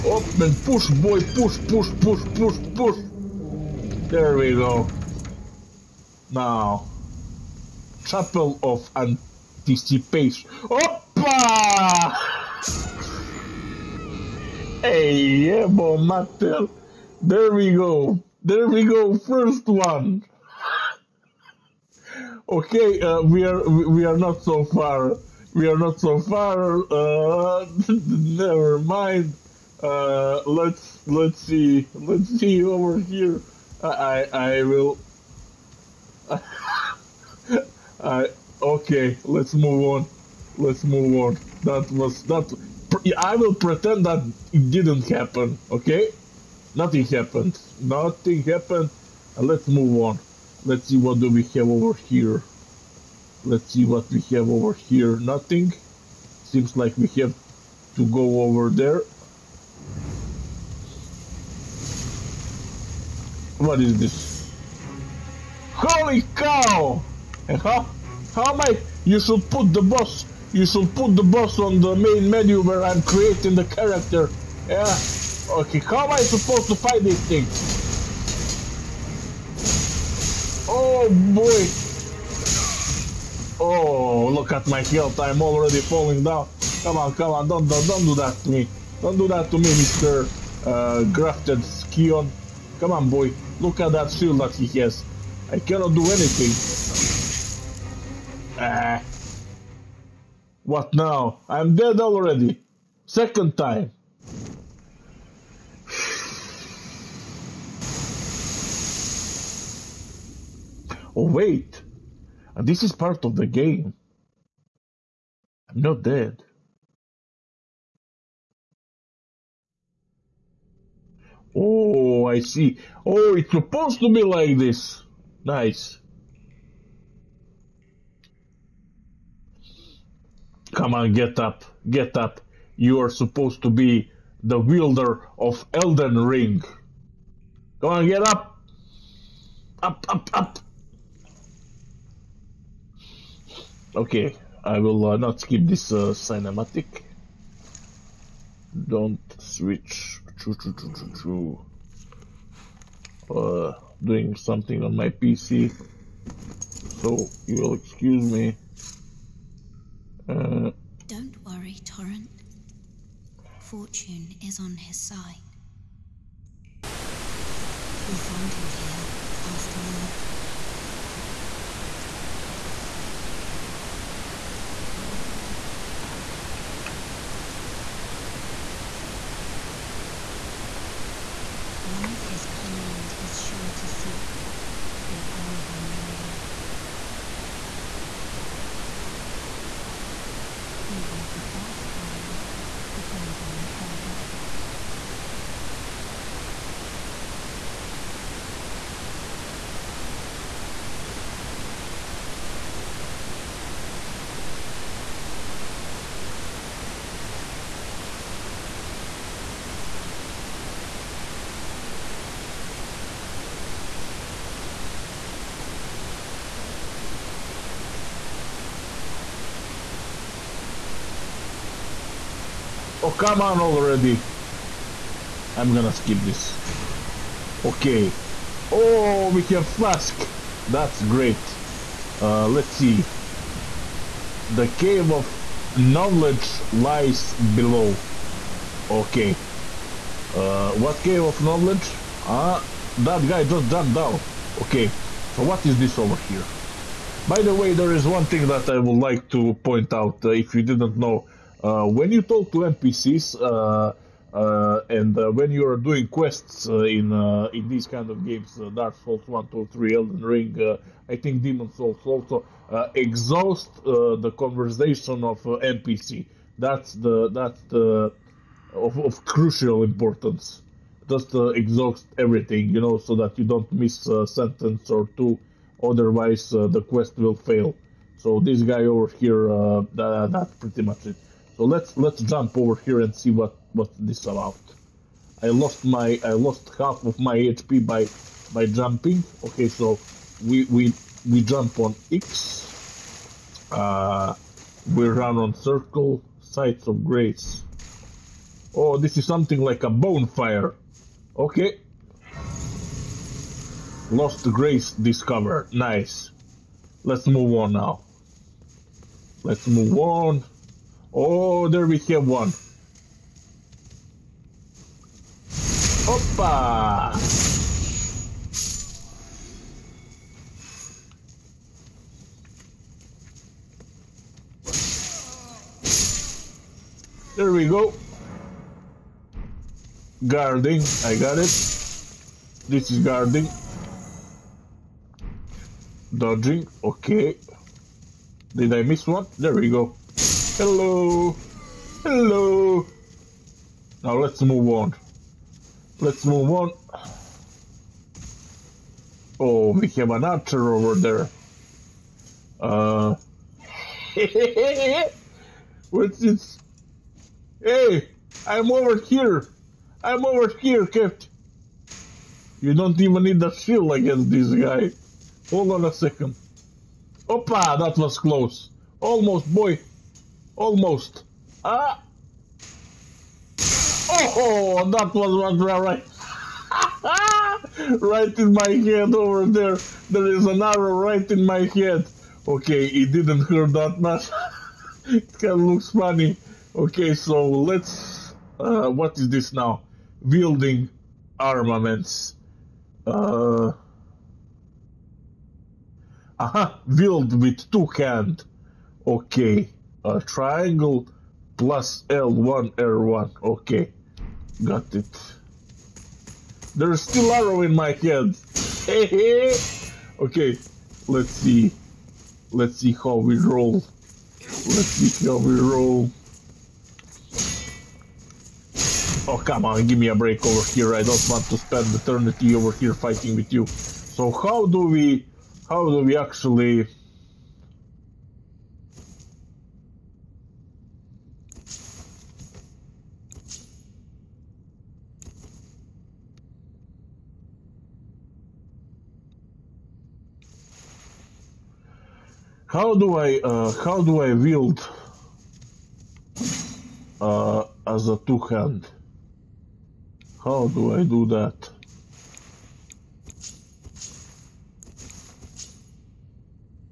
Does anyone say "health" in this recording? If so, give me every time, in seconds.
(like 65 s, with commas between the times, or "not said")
84 s.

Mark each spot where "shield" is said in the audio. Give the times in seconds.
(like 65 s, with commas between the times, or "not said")
94 s, 363 s.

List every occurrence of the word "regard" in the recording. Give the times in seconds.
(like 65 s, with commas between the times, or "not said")
not said.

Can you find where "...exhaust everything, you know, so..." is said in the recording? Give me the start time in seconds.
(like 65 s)
271 s.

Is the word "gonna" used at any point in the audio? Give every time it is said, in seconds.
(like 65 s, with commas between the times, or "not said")
225 s.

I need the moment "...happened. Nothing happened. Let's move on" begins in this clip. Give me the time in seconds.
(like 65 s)
47 s.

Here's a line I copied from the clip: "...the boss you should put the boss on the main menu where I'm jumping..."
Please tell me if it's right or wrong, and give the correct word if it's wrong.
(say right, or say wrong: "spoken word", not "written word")
wrong: "creating", not "jumping".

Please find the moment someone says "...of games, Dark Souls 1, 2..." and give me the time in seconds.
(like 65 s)
258 s.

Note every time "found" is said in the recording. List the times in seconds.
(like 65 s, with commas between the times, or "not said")
168 s.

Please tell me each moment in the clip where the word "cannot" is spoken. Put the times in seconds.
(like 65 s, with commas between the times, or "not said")
95 s.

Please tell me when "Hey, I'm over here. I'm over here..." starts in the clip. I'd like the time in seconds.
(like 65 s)
357 s.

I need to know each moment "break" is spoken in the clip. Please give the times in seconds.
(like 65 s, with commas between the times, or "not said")
420 s.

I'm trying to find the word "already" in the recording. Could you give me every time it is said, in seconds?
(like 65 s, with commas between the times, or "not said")
85 s, 101 s, 223 s.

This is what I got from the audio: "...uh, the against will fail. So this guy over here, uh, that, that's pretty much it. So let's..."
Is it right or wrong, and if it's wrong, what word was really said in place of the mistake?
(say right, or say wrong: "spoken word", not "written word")
wrong: "quest", not "against".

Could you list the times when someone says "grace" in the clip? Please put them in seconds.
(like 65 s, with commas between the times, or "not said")
297 s, 304 s.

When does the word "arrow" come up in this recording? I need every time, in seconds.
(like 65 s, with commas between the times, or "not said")
380 s, 407 s.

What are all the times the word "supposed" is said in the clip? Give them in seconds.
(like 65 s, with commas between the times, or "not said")
76 s, 123 s, 133 s.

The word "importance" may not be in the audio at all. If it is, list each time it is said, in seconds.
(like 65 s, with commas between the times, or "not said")
269 s.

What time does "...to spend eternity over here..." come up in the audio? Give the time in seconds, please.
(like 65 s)
421 s.